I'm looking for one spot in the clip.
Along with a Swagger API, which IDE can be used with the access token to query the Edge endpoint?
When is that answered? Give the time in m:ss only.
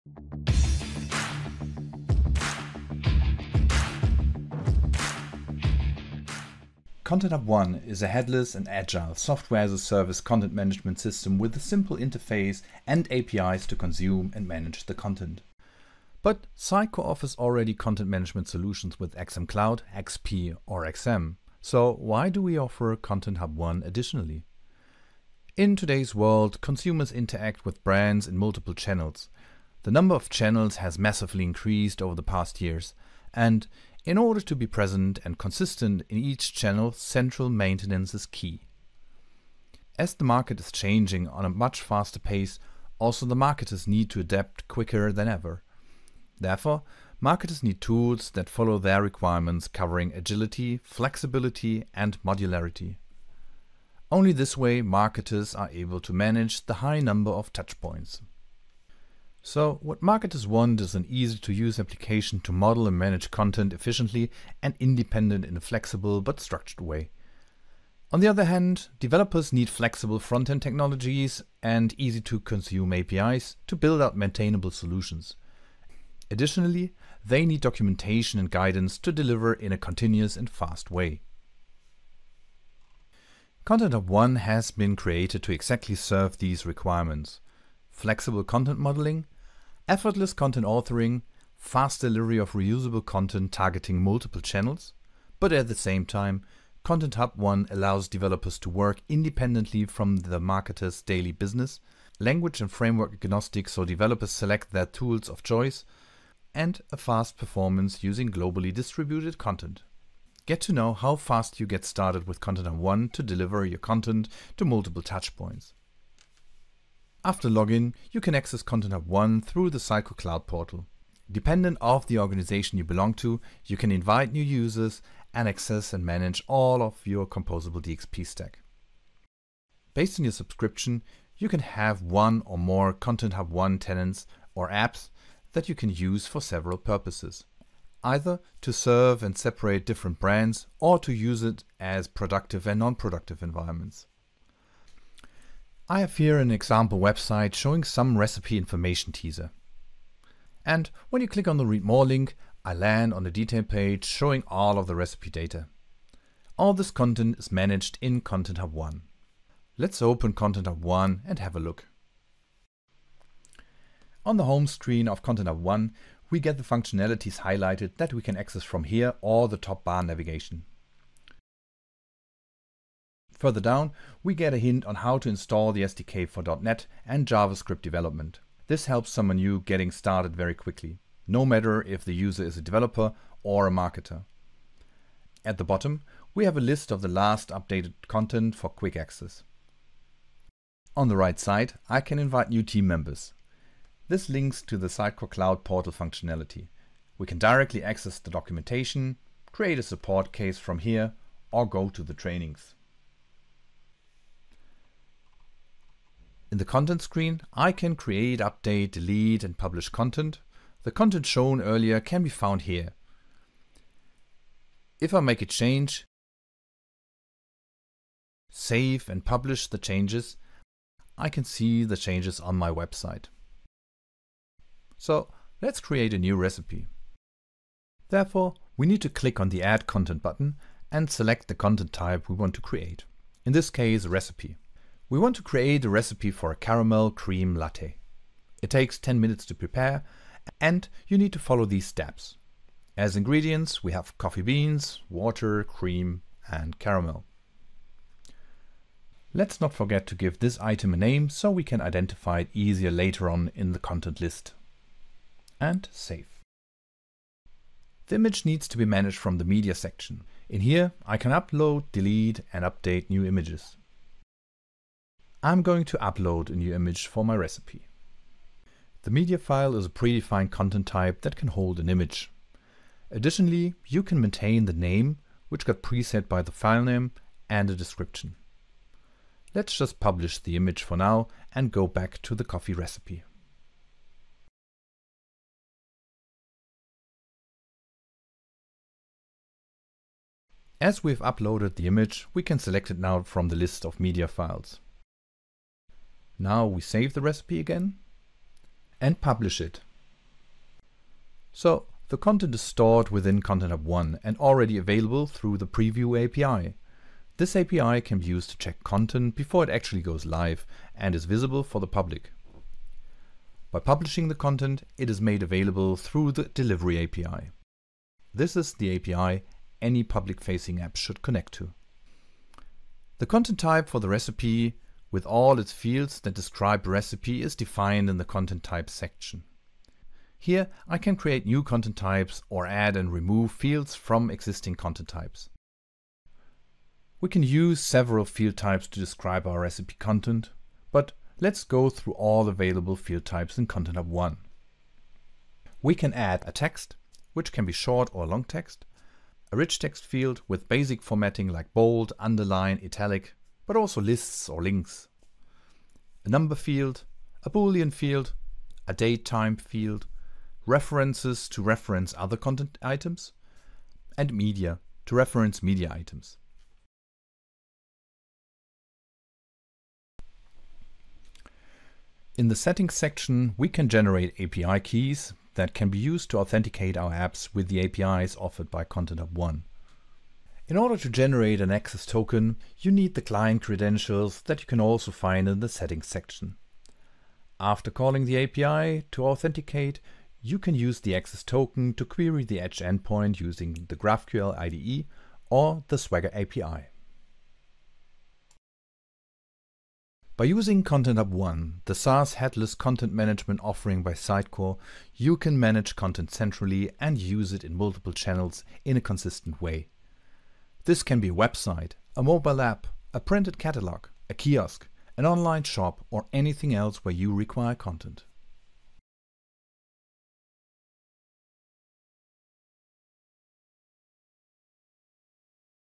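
6:33.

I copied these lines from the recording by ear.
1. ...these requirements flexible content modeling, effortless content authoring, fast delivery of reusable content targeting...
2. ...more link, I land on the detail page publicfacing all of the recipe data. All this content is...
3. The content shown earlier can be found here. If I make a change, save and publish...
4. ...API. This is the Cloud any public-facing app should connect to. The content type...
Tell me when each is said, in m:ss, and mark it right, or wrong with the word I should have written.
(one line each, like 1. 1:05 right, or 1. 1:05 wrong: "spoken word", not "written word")
1. 1:26 right
2. 2:31 wrong: "showing", not "publicfacing"
3. 3:30 right
4. 5:17 wrong: "API", not "Cloud".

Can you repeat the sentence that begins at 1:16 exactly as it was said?
Additionally, they need documentation and guidance to deliver in a continuous and fast way.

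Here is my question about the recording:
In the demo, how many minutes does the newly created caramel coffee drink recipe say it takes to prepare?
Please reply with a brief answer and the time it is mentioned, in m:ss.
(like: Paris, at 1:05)
10, at 3:58.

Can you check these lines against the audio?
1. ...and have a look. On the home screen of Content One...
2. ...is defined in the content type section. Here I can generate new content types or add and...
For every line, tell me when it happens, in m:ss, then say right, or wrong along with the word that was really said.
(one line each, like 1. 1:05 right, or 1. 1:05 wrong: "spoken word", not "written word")
1. 2:41 wrong: "Hub", not "One"
2. 5:27 wrong: "create", not "generate".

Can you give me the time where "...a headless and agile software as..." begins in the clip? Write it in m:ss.
0:08.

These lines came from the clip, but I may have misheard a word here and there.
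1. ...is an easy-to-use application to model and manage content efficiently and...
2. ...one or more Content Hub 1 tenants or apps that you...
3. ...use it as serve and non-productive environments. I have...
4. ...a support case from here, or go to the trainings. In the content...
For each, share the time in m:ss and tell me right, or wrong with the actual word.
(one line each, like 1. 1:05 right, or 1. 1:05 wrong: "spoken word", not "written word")
1. 1:00 right
2. 2:12 right
3. 2:21 wrong: "productive", not "serve"
4. 3:19 right.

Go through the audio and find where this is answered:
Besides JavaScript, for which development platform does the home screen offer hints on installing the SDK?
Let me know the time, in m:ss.
2:56.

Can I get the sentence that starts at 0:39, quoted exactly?
As the market is changing on a much faster pace, also the marketers need to adapt quicker than ever.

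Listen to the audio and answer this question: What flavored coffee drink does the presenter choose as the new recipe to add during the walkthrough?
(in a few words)
Caramel cream latte.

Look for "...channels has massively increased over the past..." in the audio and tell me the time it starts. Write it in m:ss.
0:30.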